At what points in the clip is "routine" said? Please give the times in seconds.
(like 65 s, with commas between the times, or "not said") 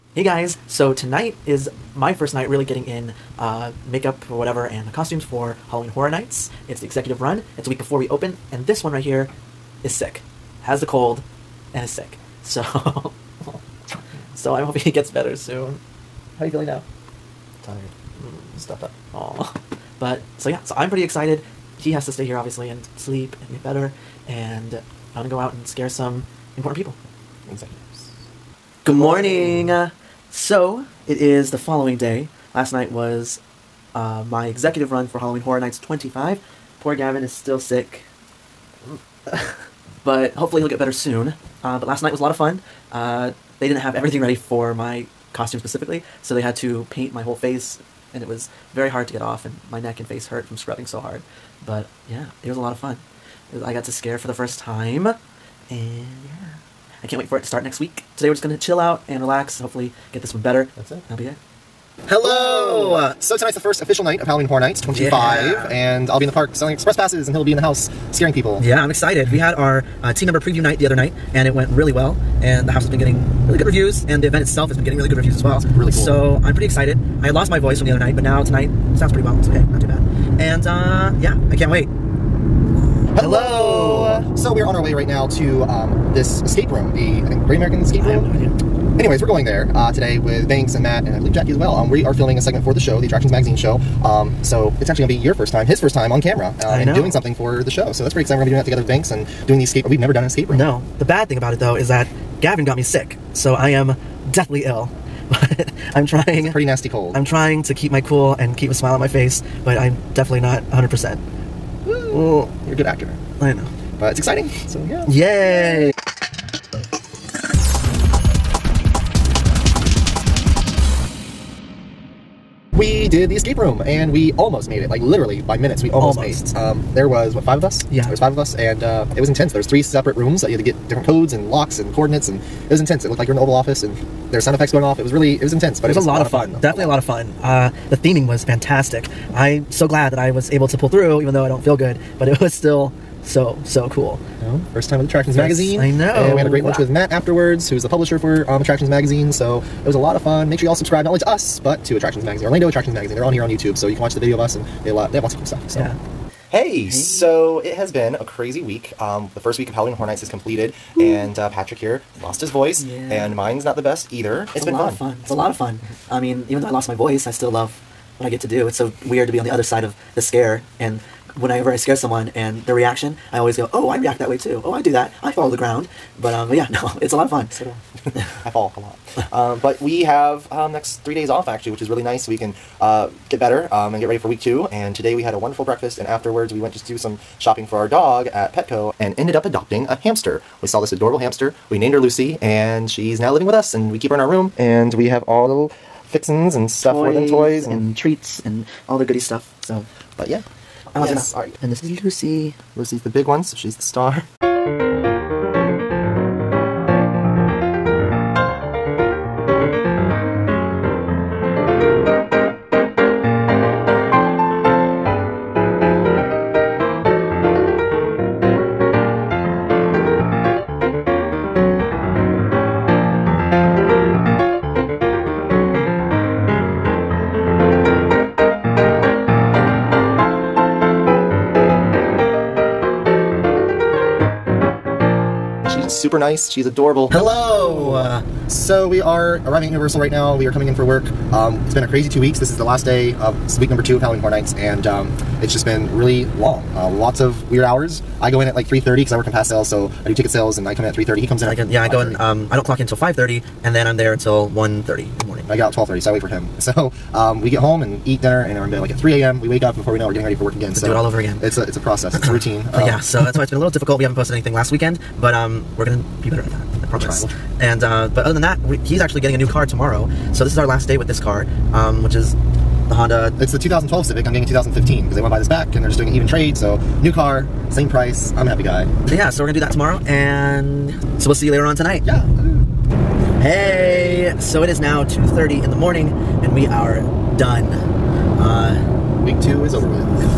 262 s.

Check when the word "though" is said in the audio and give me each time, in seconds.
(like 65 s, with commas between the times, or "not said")
101 s, 141 s, 166 s.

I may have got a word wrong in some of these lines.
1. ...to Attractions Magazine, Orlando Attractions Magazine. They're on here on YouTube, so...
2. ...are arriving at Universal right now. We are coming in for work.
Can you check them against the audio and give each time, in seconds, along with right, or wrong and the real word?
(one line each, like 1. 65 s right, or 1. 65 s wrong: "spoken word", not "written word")
1. 151 s right
2. 238 s right.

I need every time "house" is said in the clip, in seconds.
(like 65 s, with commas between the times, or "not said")
67 s, 72 s.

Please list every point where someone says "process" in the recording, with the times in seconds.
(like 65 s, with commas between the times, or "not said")
261 s.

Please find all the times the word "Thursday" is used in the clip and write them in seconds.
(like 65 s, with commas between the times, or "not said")
not said.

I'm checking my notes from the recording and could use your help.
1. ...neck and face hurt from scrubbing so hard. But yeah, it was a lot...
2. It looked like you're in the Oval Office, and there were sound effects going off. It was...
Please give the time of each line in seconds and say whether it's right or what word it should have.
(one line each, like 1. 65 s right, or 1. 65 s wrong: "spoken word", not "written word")
1. 49 s right
2. 133 s right.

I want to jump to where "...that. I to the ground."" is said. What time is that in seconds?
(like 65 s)
174 s.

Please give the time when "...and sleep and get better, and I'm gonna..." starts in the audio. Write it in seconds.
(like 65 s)
22 s.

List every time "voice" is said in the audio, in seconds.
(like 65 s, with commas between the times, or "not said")
77 s, 162 s, 166 s.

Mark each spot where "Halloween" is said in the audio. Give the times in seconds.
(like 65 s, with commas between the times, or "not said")
5 s, 35 s, 64 s, 159 s, 244 s.